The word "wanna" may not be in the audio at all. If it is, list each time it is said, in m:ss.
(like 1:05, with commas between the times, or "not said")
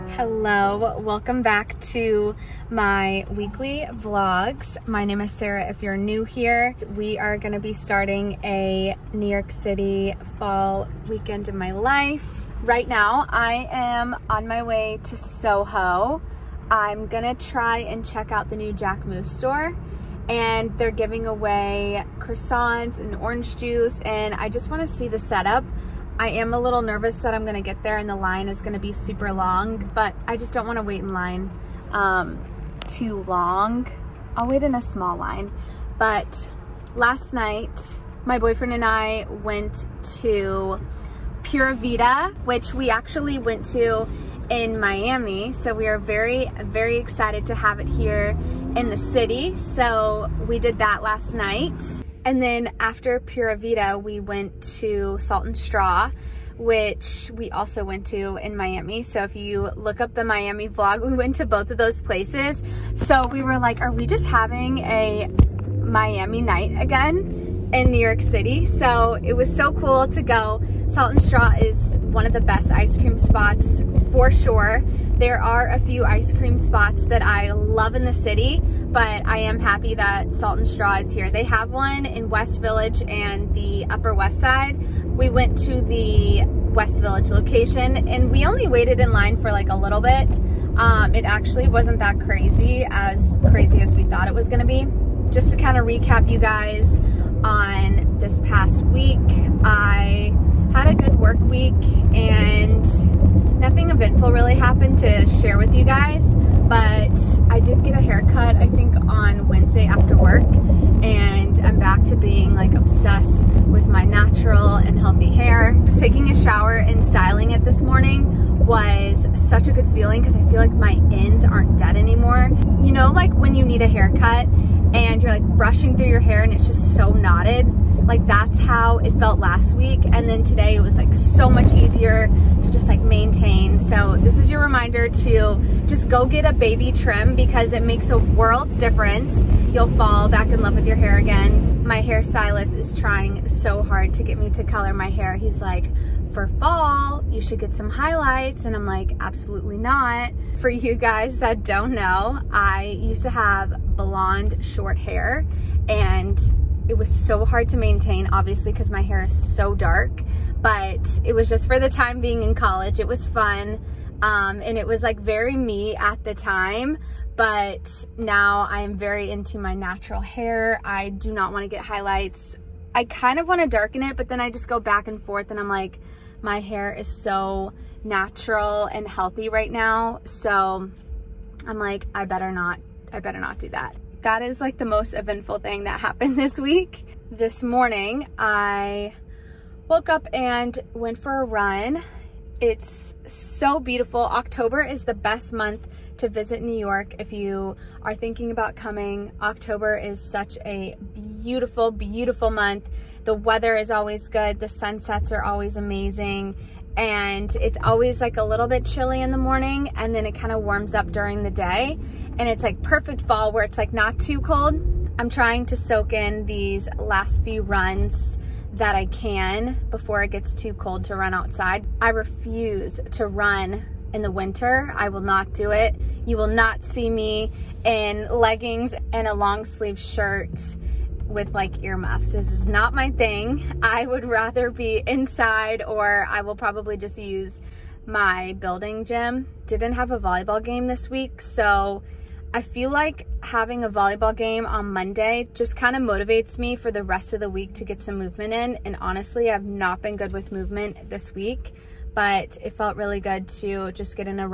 0:24, 0:30.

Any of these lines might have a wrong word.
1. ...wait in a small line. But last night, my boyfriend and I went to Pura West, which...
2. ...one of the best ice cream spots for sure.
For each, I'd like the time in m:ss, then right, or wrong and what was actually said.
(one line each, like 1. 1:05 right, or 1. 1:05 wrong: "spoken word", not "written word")
1. 0:34 wrong: "Vida", not "West"
2. 1:11 right.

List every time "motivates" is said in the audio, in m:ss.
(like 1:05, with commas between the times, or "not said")
4:06.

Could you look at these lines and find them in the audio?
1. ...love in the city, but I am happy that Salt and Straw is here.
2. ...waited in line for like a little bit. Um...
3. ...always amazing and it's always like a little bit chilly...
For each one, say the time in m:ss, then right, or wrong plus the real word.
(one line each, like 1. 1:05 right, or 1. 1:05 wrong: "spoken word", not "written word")
1. 1:17 right
2. 1:28 right
3. 3:25 right.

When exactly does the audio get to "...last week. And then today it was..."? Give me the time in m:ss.
2:09.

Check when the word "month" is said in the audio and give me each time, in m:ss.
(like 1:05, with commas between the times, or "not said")
3:15, 3:22.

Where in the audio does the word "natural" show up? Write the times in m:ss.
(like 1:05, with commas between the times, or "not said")
1:54, 2:49, 2:58.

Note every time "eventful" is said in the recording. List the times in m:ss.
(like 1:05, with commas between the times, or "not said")
1:43, 3:05.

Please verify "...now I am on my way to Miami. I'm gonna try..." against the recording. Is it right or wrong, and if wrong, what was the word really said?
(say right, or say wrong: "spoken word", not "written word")
wrong: "Soho", not "Miami".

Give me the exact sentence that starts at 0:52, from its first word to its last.
And then after Pura Vida, we went to Salt and Straw, which we also went to in Miami.